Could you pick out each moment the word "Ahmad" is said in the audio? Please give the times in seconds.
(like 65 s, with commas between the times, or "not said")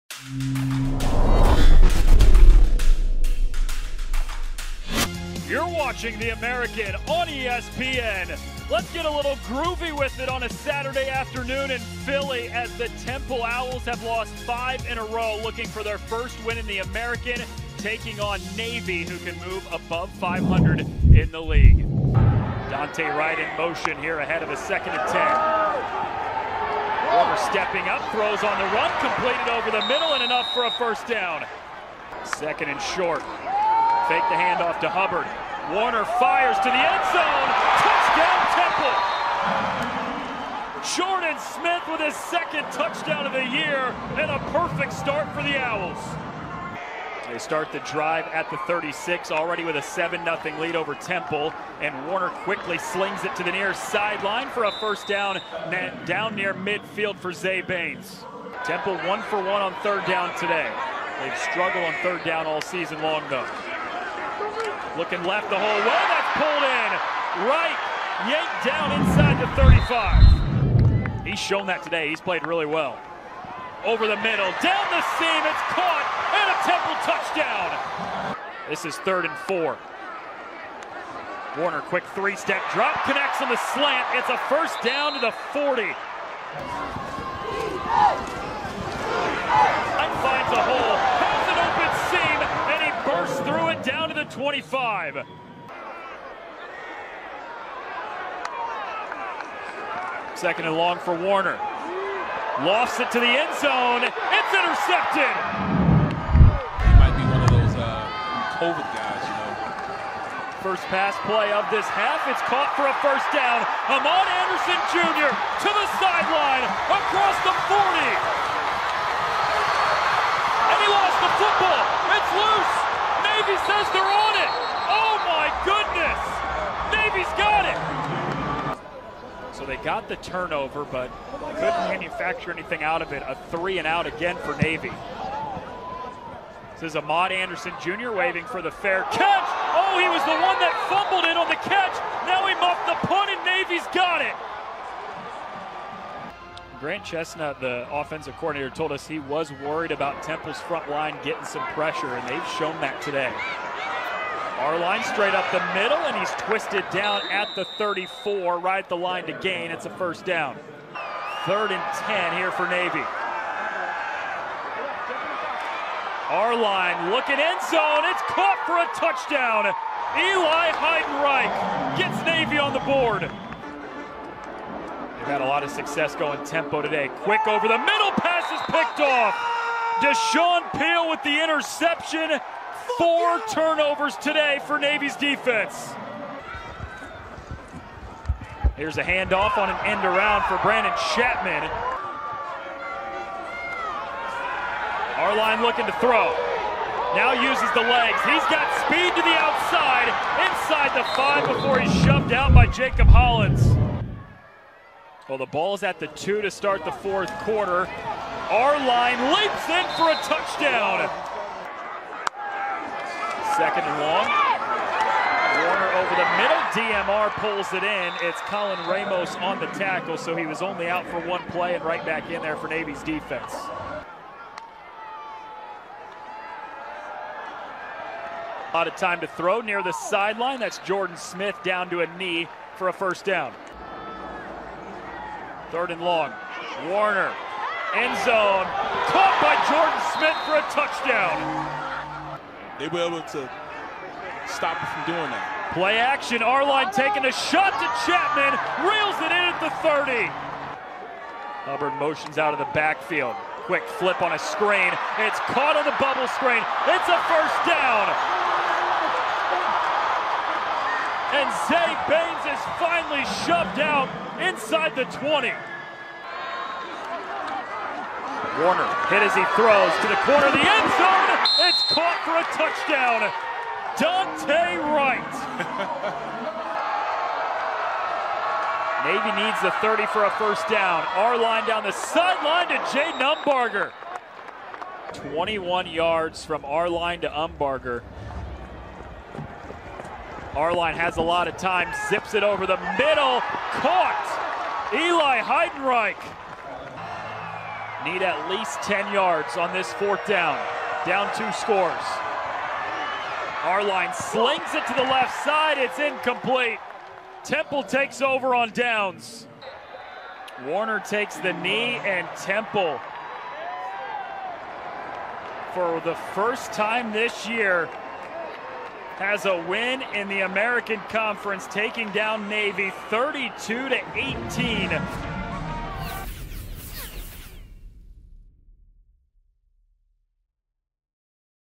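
113 s, 136 s.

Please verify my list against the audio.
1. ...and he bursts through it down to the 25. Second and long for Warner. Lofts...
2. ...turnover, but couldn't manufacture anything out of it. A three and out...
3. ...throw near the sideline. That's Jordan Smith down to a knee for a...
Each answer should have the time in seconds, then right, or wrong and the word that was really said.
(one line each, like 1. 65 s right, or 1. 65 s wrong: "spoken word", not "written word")
1. 92 s right
2. 130 s right
3. 229 s right.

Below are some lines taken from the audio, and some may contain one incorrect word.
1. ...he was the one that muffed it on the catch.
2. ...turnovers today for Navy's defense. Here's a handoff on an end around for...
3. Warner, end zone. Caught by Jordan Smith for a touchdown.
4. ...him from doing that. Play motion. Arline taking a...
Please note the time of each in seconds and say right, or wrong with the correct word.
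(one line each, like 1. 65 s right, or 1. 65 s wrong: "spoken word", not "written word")
1. 140 s wrong: "fumbled", not "muffed"
2. 183 s right
3. 236 s right
4. 244 s wrong: "action", not "motion".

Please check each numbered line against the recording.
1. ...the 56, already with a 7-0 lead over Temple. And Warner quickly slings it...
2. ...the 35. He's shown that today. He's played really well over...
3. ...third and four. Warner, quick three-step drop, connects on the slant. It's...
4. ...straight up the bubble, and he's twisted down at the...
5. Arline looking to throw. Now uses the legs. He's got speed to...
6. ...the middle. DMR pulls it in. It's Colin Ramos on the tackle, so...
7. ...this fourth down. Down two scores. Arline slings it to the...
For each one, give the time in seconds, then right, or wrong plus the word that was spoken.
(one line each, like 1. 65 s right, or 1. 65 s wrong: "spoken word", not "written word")
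1. 48 s wrong: "36", not "56"
2. 69 s right
3. 79 s right
4. 155 s wrong: "middle", not "bubble"
5. 195 s right
6. 216 s right
7. 299 s right.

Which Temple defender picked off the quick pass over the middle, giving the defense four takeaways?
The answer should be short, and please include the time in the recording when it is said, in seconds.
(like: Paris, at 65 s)
Deshaun Peel, at 180 s.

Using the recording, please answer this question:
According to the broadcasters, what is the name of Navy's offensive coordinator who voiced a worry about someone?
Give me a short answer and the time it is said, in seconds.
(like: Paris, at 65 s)
Grant Chesnut, at 146 s.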